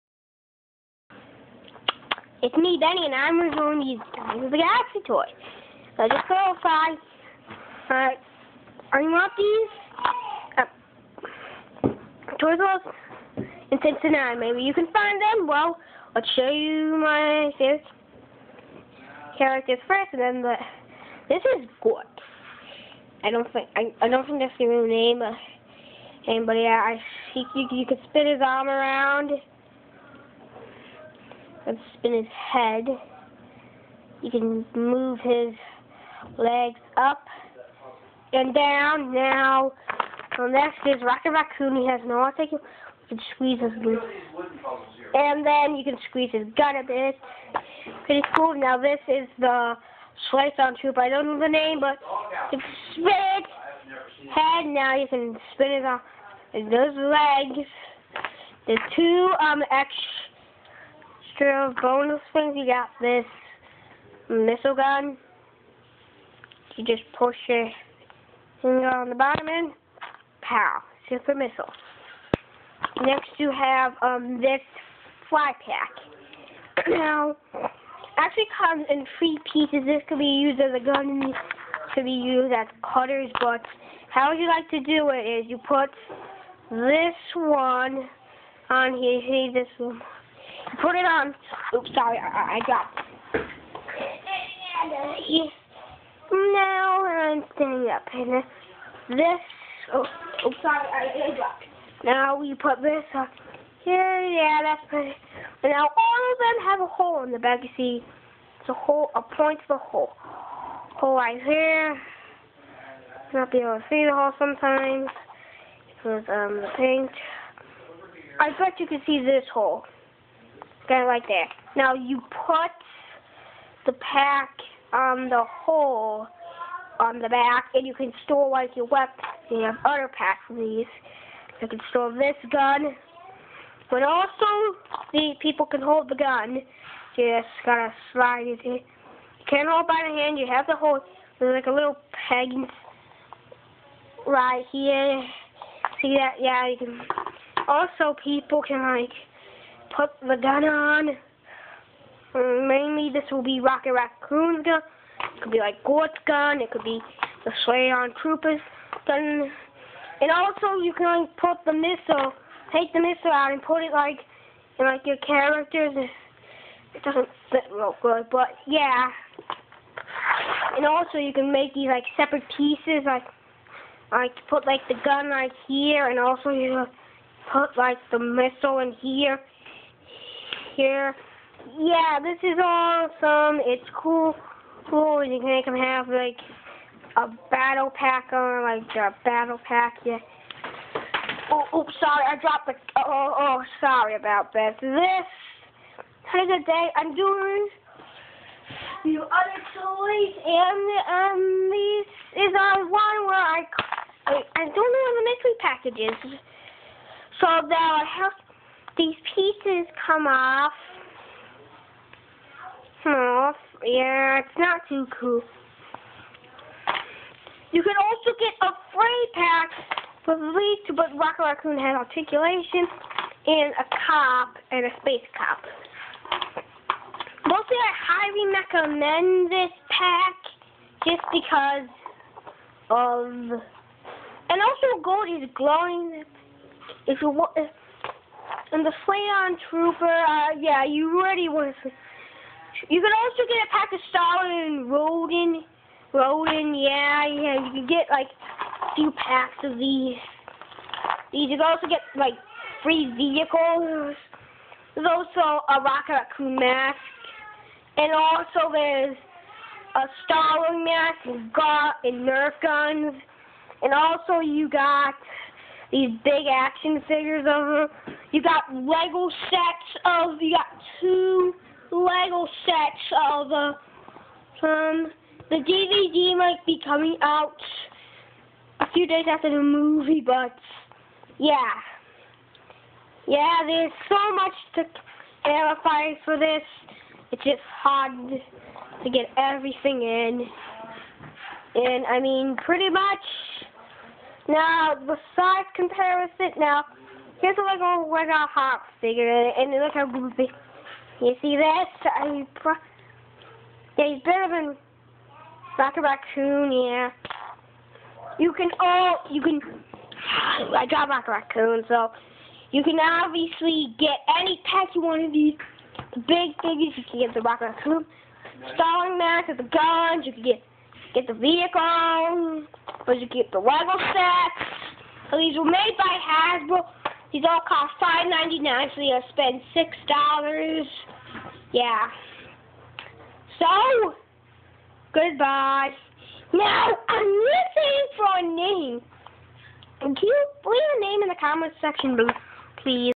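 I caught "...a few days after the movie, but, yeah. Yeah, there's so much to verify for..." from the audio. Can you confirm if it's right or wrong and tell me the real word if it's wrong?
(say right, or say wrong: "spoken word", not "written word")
right.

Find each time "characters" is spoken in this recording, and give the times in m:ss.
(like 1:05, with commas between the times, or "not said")
0:19, 2:45.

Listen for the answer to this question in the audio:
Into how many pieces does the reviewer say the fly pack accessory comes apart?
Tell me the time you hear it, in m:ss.
1:19.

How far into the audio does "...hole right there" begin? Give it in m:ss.
1:59.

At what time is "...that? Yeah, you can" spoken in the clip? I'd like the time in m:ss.
2:26.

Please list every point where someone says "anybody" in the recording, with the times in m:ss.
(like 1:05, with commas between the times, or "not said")
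0:26.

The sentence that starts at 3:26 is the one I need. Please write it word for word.
So So I have these pieces come off.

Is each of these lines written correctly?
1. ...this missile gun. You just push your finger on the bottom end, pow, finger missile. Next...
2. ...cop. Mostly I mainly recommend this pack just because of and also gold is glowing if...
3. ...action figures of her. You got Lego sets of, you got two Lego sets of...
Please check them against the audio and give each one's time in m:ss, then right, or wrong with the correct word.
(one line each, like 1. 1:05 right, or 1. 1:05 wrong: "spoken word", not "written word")
1. 1:02 wrong: "super", not "finger"
2. 3:45 wrong: "highly", not "mainly"
3. 4:26 right.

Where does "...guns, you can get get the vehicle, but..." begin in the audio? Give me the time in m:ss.
5:19.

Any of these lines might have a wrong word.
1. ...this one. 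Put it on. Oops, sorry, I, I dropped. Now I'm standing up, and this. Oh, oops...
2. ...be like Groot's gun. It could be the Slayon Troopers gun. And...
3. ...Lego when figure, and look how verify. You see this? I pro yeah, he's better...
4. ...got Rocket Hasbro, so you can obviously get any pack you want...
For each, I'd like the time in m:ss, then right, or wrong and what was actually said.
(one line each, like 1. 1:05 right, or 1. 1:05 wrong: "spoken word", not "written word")
1. 1:29 right
2. 2:35 right
3. 4:58 wrong: "goofy", not "verify"
4. 5:10 wrong: "Raccoon", not "Hasbro".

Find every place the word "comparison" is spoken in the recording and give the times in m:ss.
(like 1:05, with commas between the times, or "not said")
4:55.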